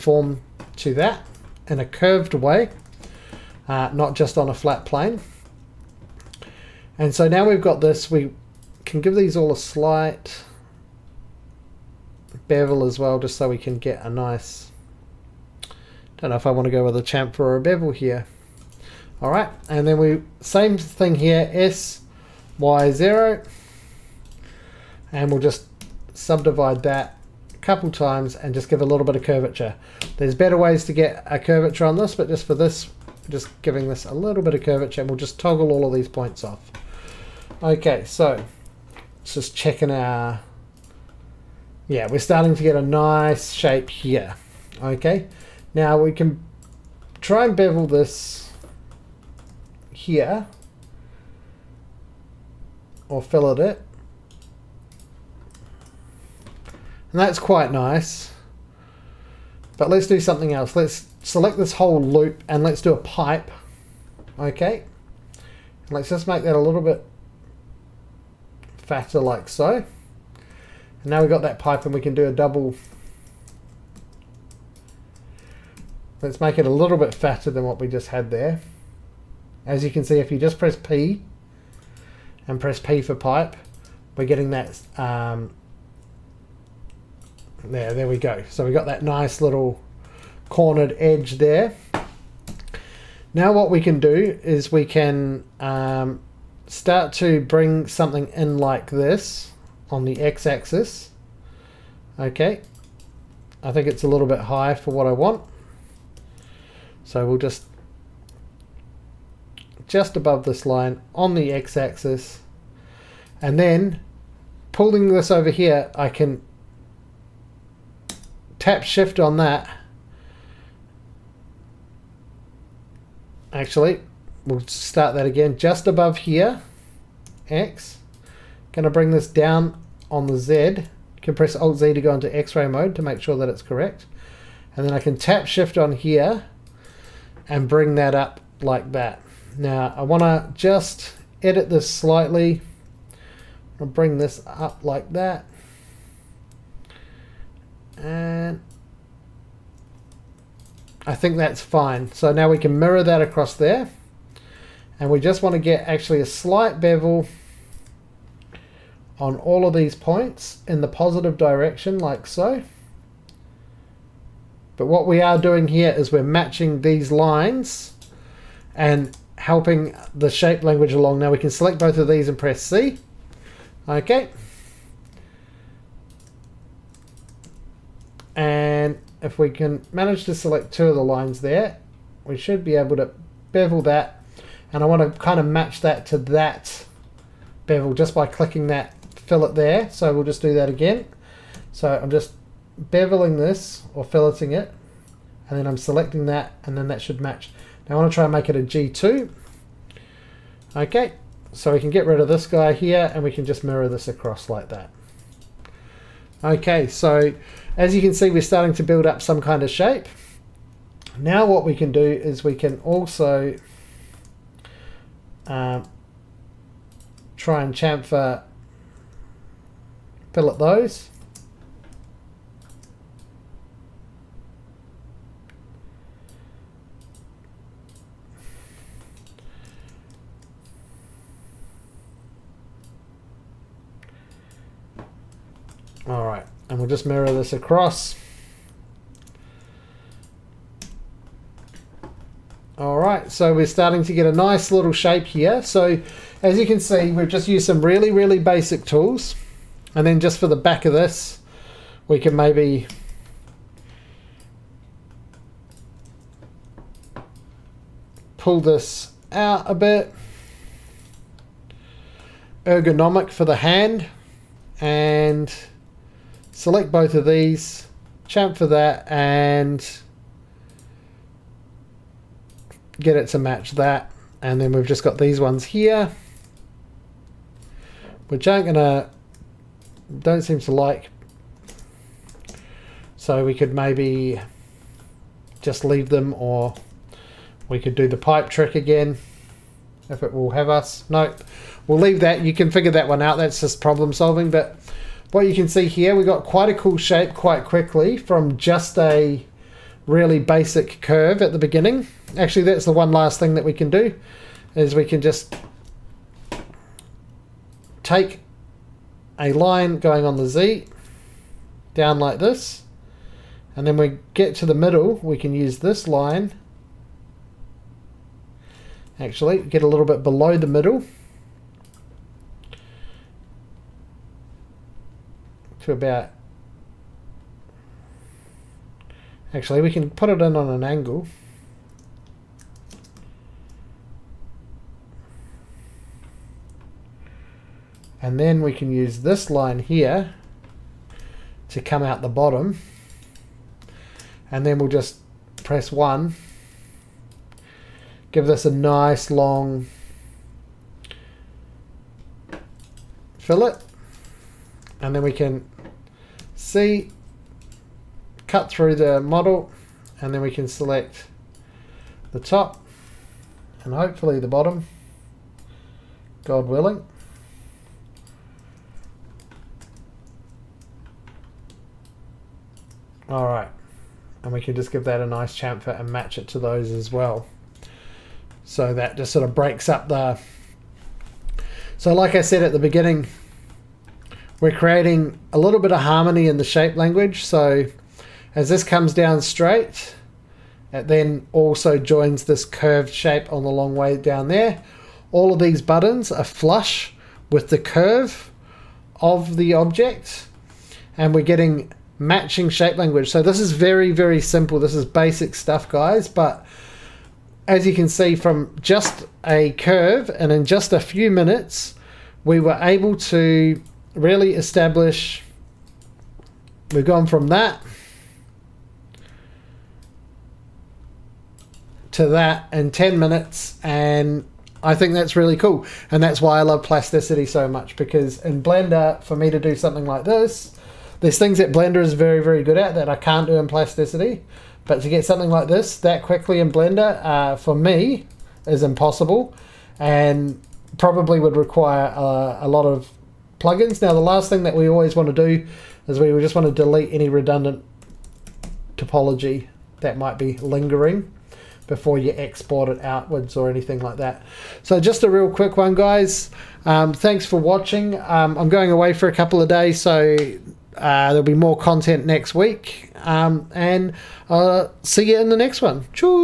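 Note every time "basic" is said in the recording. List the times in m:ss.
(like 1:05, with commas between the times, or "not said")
4:08, 5:00, 6:45.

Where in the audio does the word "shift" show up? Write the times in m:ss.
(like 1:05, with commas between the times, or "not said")
1:58, 2:15.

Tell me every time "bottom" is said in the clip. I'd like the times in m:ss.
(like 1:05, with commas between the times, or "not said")
5:42, 6:04.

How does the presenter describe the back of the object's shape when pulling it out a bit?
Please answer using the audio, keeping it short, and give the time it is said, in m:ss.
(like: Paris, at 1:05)
Ergonomic, at 4:22.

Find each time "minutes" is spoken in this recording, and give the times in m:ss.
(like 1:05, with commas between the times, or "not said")
6:51, 7:03.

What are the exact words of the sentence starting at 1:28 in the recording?
So we got that nice little cornered edge there.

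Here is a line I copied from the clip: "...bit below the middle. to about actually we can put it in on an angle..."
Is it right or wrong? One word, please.
right.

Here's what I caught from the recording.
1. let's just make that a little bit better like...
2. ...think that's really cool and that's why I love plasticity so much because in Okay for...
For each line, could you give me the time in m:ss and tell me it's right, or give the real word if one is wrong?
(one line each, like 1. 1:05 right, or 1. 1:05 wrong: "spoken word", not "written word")
1. 1:05 wrong: "fatter", not "better"
2. 7:04 wrong: "Blender", not "Okay".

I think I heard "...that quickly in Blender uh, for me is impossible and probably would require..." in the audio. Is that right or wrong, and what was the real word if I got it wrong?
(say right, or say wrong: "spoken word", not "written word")
right.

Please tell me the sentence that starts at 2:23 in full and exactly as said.
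I'll bring this up like that.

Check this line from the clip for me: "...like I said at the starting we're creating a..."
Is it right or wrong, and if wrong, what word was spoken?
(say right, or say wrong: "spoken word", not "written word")
wrong: "beginning", not "starting".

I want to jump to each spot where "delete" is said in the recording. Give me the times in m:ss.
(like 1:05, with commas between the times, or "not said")
7:26.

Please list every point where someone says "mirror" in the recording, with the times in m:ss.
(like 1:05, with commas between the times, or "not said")
2:32, 3:23, 3:57.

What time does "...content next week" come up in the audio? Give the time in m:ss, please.
7:41.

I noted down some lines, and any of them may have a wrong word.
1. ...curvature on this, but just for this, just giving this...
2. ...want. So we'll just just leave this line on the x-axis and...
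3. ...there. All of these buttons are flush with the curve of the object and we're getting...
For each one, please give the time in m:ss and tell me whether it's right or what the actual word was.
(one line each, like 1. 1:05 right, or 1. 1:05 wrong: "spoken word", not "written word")
1. 0:31 right
2. 1:45 wrong: "above", not "leave"
3. 6:34 right.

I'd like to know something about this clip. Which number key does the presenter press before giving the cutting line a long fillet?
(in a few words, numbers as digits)
1.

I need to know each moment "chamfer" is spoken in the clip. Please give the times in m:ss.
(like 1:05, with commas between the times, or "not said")
0:17, 3:37, 4:28, 6:15.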